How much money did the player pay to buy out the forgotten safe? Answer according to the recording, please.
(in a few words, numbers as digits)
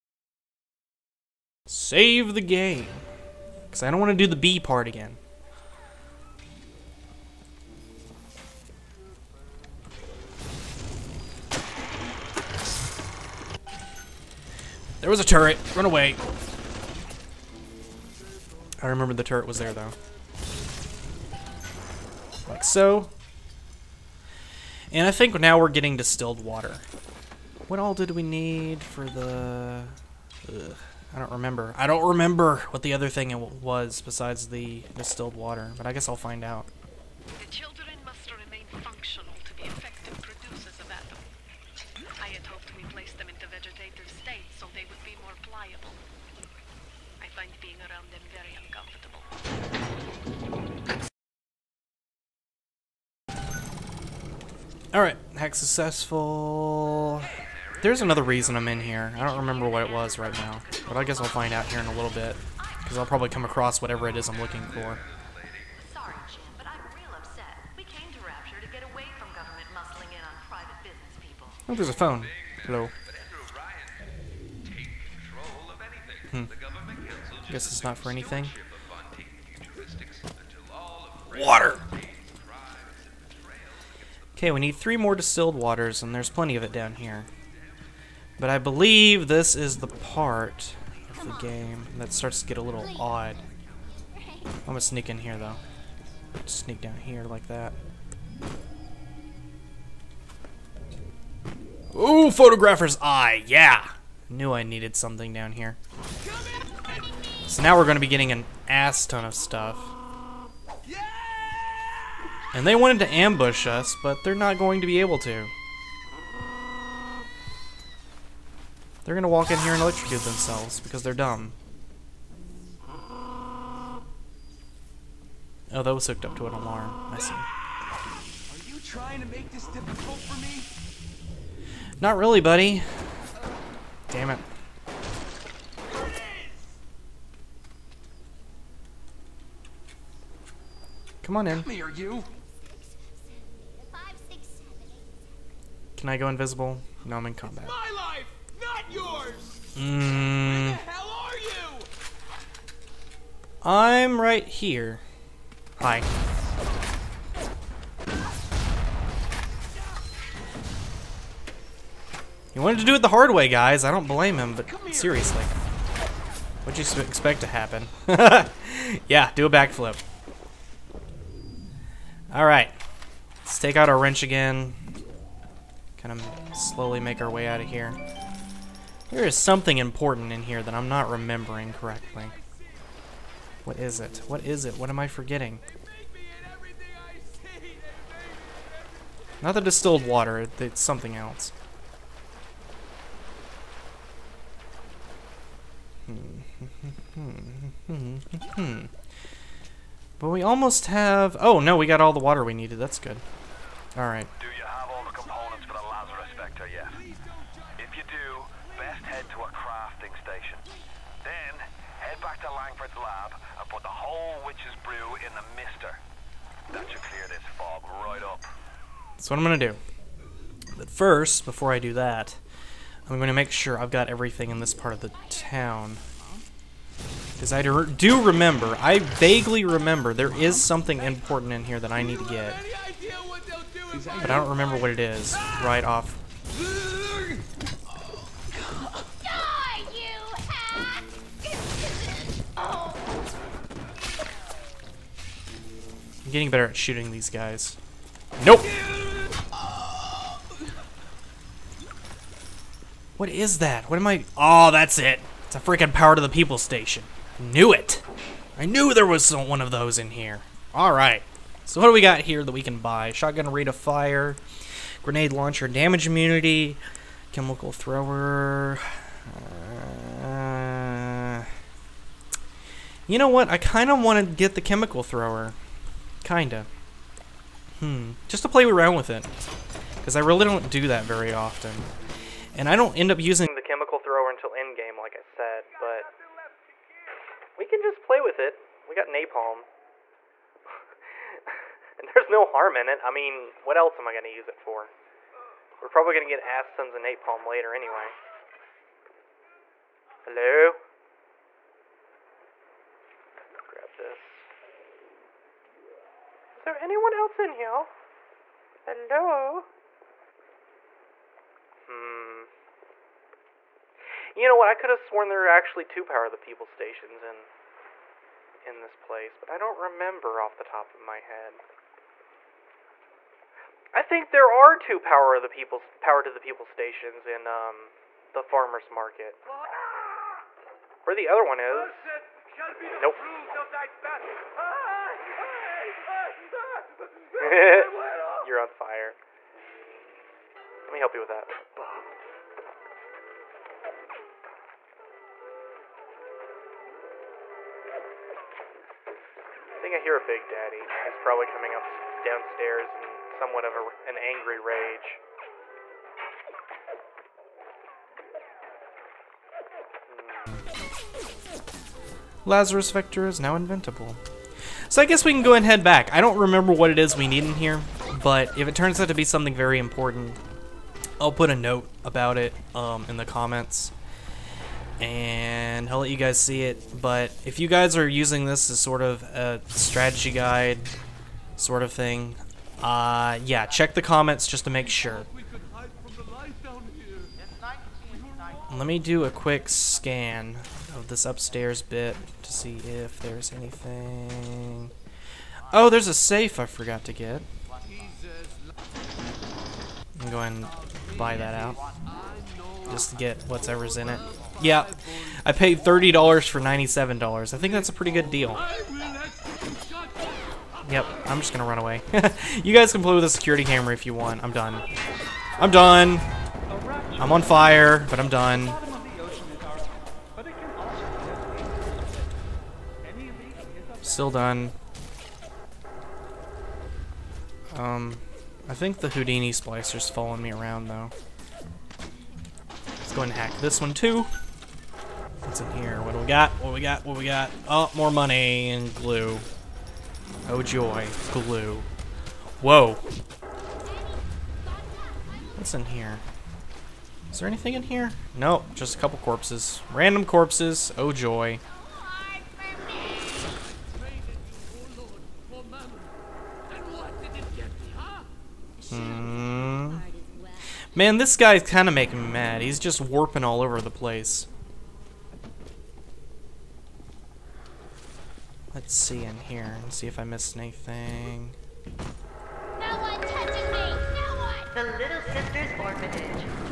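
$30.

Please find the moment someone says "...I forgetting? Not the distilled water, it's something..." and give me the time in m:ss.
3:05.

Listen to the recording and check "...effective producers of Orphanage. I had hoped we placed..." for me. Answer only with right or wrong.
wrong.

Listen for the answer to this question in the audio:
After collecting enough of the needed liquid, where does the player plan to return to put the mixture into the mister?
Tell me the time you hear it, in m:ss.
3:32.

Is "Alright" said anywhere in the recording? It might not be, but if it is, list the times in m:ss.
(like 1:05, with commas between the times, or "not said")
0:54, 2:52, 3:23.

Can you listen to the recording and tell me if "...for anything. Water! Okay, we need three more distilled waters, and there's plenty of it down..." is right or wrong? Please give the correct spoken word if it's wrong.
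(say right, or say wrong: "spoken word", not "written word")
right.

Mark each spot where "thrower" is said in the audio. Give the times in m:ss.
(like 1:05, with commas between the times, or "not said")
4:27, 4:35, 4:43.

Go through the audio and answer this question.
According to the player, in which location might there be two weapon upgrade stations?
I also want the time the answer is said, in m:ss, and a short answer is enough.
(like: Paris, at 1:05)
The farmers market, at 5:28.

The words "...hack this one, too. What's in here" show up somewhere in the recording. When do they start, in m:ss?
7:13.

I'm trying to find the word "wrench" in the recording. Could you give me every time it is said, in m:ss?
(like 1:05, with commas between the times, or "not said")
2:53.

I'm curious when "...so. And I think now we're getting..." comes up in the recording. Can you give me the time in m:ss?
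0:22.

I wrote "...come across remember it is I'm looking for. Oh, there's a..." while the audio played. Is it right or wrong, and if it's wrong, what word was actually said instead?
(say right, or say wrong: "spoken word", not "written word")
wrong: "whatever", not "remember".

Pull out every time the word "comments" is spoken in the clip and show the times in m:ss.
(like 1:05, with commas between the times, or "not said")
6:13, 6:24.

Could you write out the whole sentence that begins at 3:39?
That's what I'm going to do.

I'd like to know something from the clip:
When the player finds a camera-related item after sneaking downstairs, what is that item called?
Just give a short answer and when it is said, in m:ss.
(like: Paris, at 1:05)
Photographer's eye, at 1:42.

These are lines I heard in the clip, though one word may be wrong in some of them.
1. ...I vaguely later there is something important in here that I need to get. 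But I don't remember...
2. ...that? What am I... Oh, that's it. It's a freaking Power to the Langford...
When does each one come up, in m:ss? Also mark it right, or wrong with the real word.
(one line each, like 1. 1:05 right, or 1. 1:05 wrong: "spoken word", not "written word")
1. 3:48 wrong: "remember", not "later"
2. 4:13 wrong: "People", not "Langford".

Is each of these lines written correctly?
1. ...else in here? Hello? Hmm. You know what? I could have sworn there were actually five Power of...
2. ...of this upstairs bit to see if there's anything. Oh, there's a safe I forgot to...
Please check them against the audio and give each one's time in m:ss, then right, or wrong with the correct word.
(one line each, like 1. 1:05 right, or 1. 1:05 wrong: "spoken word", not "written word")
1. 5:07 wrong: "two", not "five"
2. 6:30 right.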